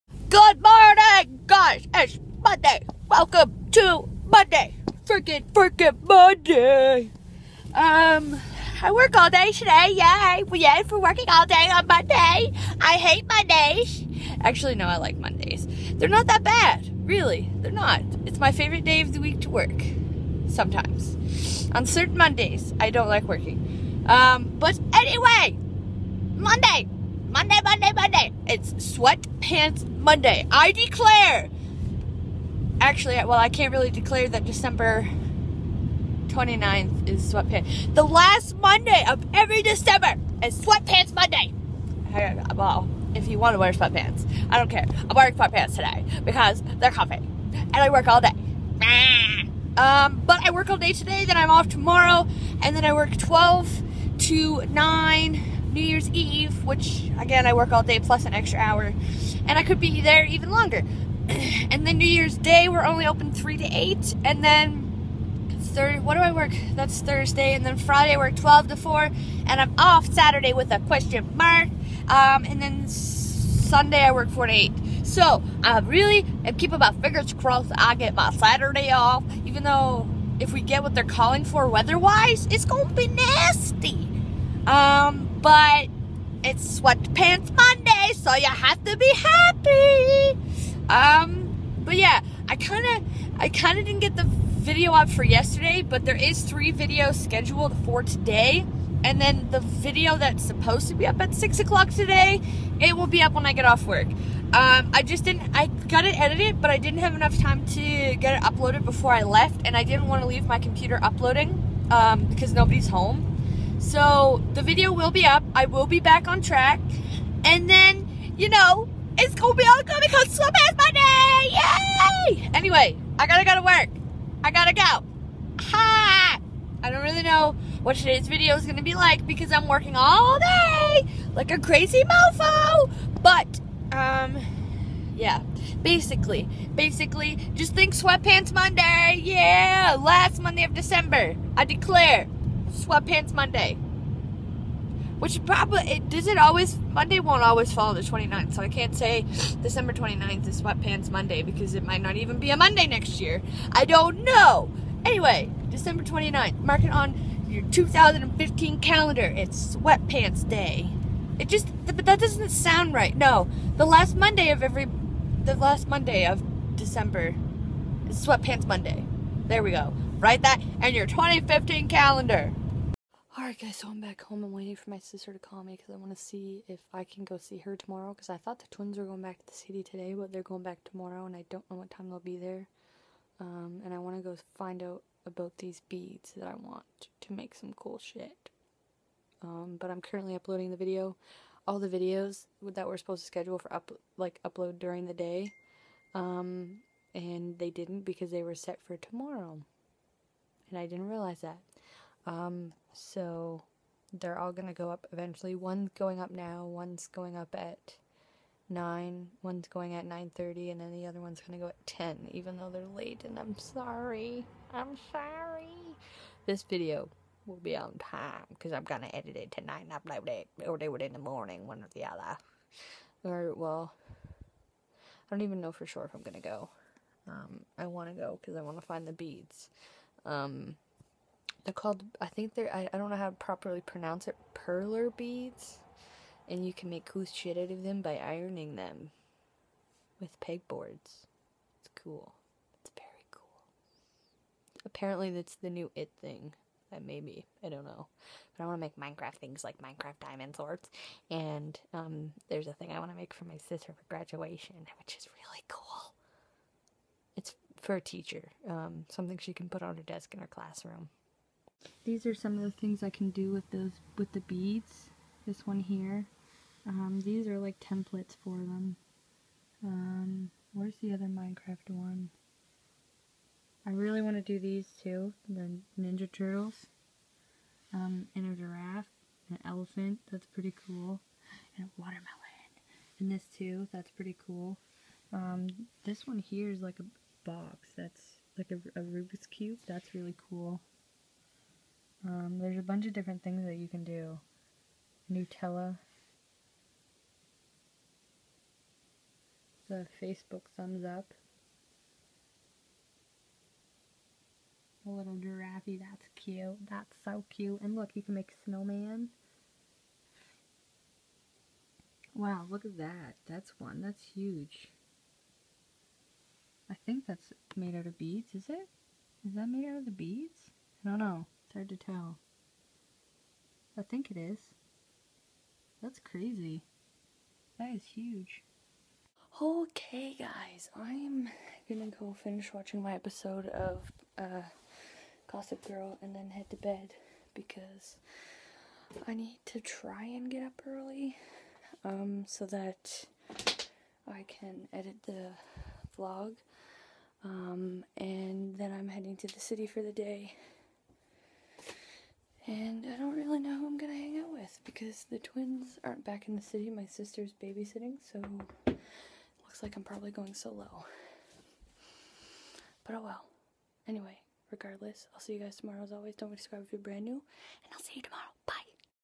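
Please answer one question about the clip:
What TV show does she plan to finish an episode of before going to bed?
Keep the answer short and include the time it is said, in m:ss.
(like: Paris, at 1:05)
Gossip Girl, at 5:35.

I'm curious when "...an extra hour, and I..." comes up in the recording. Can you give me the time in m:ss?
0:58.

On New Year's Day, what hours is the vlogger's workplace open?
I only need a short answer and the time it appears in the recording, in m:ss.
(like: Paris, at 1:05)
3 to 8, at 1:03.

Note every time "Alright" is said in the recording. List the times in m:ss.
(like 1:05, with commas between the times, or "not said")
2:53.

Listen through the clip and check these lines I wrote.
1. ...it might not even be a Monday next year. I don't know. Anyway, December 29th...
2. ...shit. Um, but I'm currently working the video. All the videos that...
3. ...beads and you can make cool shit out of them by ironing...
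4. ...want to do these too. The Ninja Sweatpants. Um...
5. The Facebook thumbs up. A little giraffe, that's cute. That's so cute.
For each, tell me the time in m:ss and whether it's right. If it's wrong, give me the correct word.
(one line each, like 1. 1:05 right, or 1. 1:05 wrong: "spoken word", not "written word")
1. 2:31 right
2. 3:07 wrong: "uploading", not "working"
3. 3:55 right
4. 4:34 wrong: "Turtles", not "Sweatpants"
5. 4:59 right.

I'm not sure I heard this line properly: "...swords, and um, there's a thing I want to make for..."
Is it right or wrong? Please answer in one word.
right.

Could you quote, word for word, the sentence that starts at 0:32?
Actually, well, I can't really declare that December 29th is Sweatpants.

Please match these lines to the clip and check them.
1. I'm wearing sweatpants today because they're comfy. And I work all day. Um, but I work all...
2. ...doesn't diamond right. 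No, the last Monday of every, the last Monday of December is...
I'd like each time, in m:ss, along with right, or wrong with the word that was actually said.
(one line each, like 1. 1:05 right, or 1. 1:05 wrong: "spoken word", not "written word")
1. 0:45 right
2. 2:42 wrong: "sound", not "diamond".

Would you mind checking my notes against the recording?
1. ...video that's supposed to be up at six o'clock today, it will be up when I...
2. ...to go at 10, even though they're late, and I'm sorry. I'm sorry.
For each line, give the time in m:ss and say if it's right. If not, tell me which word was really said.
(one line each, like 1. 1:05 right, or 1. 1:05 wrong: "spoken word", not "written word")
1. 1:39 right
2. 3:31 right.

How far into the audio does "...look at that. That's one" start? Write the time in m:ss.
5:12.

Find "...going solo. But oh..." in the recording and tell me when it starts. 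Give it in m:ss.
6:00.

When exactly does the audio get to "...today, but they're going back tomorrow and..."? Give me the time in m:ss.
2:59.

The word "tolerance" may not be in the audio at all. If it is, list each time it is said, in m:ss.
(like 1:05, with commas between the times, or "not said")
not said.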